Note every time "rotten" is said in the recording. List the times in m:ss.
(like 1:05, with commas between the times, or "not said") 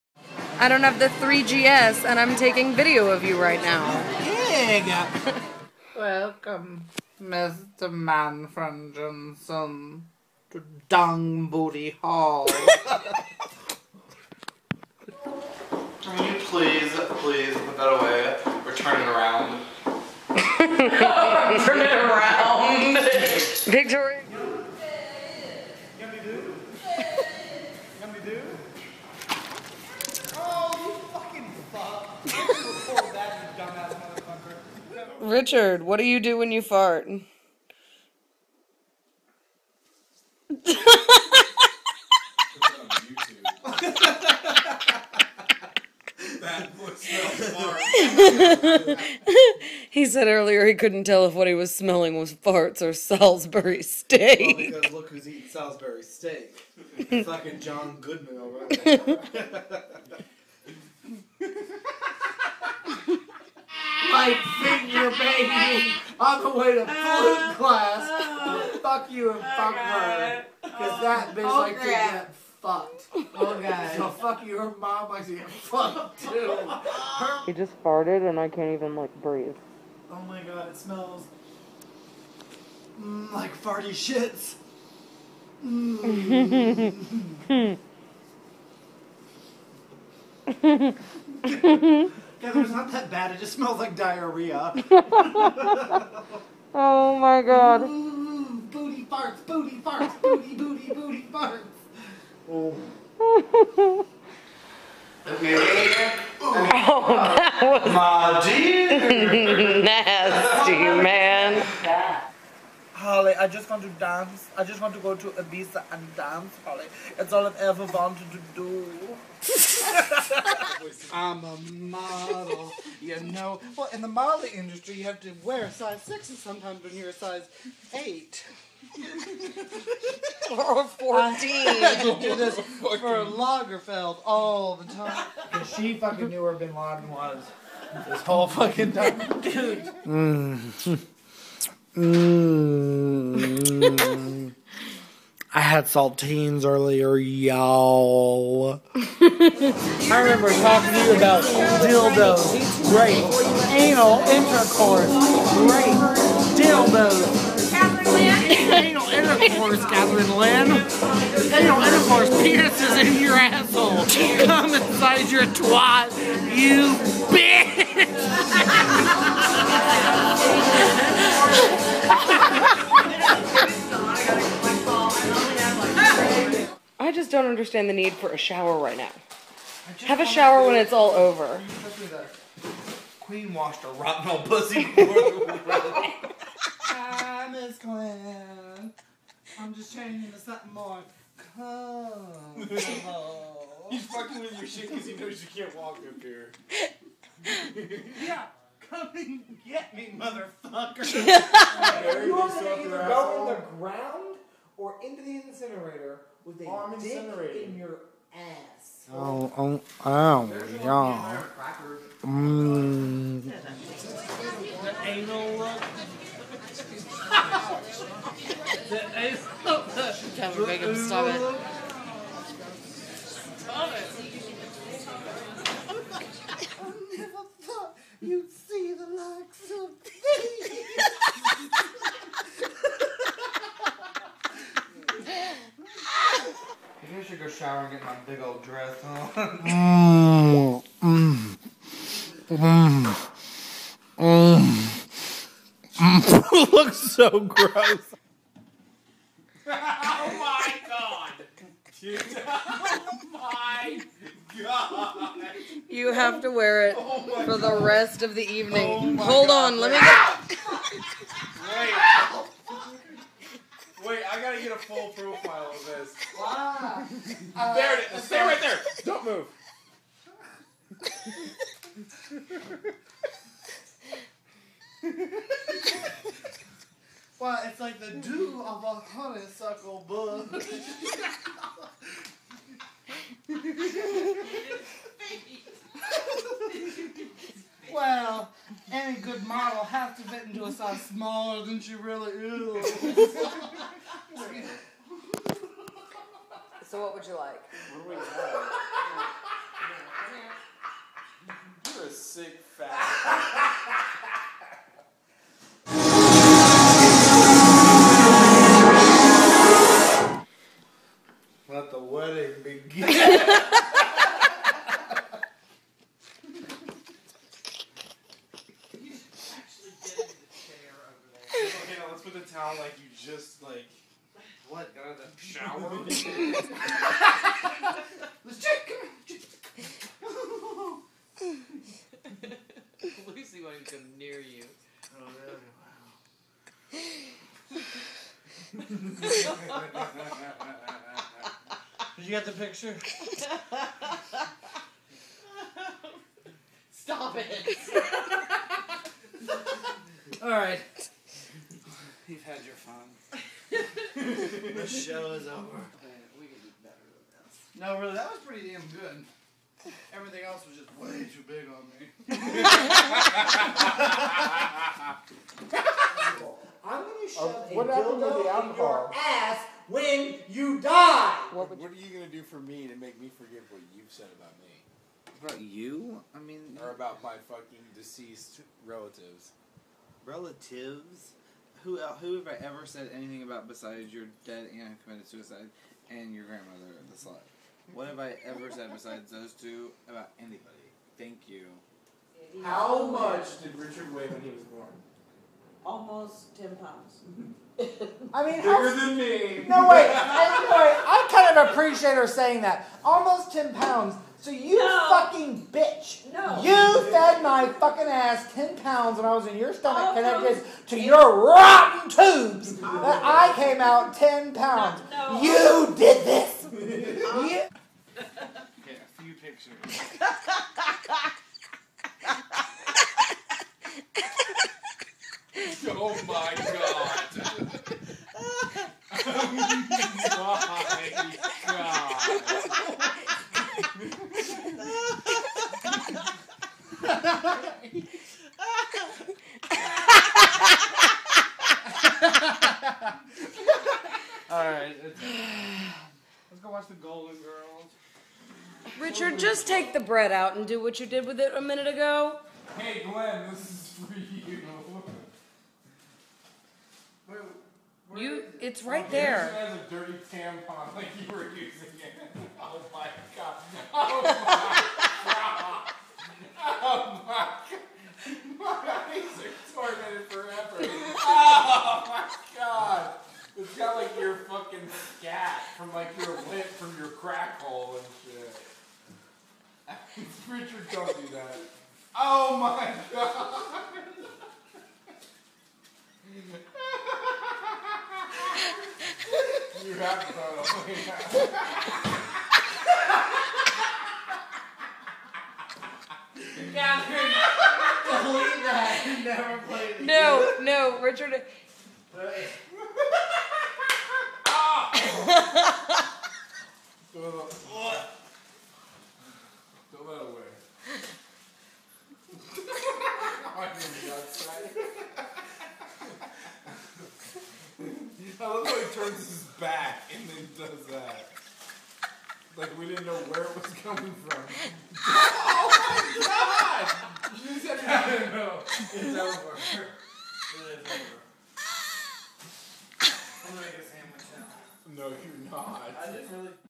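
3:03, 6:51.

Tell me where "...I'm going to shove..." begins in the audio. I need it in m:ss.
6:06.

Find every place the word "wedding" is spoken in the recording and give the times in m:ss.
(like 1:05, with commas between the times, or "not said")
3:05, 5:11.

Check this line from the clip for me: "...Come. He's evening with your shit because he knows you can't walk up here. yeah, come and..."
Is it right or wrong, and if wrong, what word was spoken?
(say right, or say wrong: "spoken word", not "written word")
wrong: "fucking", not "evening".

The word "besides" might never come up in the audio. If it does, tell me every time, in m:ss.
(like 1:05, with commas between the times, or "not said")
6:23, 6:28.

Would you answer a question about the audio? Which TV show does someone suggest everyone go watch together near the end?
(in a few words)
The Golden Girls.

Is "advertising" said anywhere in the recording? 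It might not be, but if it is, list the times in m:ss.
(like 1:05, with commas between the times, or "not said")
not said.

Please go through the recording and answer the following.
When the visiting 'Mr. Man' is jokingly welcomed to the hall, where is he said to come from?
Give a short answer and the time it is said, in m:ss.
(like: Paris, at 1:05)
Johnson, at 0:08.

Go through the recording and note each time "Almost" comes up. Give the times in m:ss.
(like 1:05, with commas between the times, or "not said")
6:35, 6:43.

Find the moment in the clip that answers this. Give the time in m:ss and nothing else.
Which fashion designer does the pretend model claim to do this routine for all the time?
2:12.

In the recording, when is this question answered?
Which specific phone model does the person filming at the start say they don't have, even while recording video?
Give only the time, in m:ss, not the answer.
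0:01.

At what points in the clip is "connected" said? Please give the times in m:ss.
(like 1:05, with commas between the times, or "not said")
6:50.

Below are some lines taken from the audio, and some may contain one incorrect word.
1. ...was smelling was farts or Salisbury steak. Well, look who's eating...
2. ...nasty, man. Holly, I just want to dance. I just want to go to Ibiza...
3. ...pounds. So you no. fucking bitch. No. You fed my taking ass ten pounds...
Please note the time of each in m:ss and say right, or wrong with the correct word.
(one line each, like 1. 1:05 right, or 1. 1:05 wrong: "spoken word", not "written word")
1. 0:51 right
2. 1:49 right
3. 6:43 wrong: "fucking", not "taking".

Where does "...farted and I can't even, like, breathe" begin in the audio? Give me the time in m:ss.
1:17.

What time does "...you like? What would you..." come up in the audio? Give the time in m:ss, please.
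4:57.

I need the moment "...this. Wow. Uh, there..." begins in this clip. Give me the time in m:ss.
4:25.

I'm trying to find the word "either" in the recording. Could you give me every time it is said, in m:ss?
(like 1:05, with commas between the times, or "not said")
3:22.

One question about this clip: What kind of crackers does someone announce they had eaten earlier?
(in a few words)
Saltines.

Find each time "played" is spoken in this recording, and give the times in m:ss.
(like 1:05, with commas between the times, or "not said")
8:19.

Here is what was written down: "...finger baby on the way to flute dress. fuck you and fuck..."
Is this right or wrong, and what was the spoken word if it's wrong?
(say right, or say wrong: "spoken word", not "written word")
wrong: "class", not "dress".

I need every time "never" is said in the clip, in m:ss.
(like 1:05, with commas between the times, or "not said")
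3:47, 8:19.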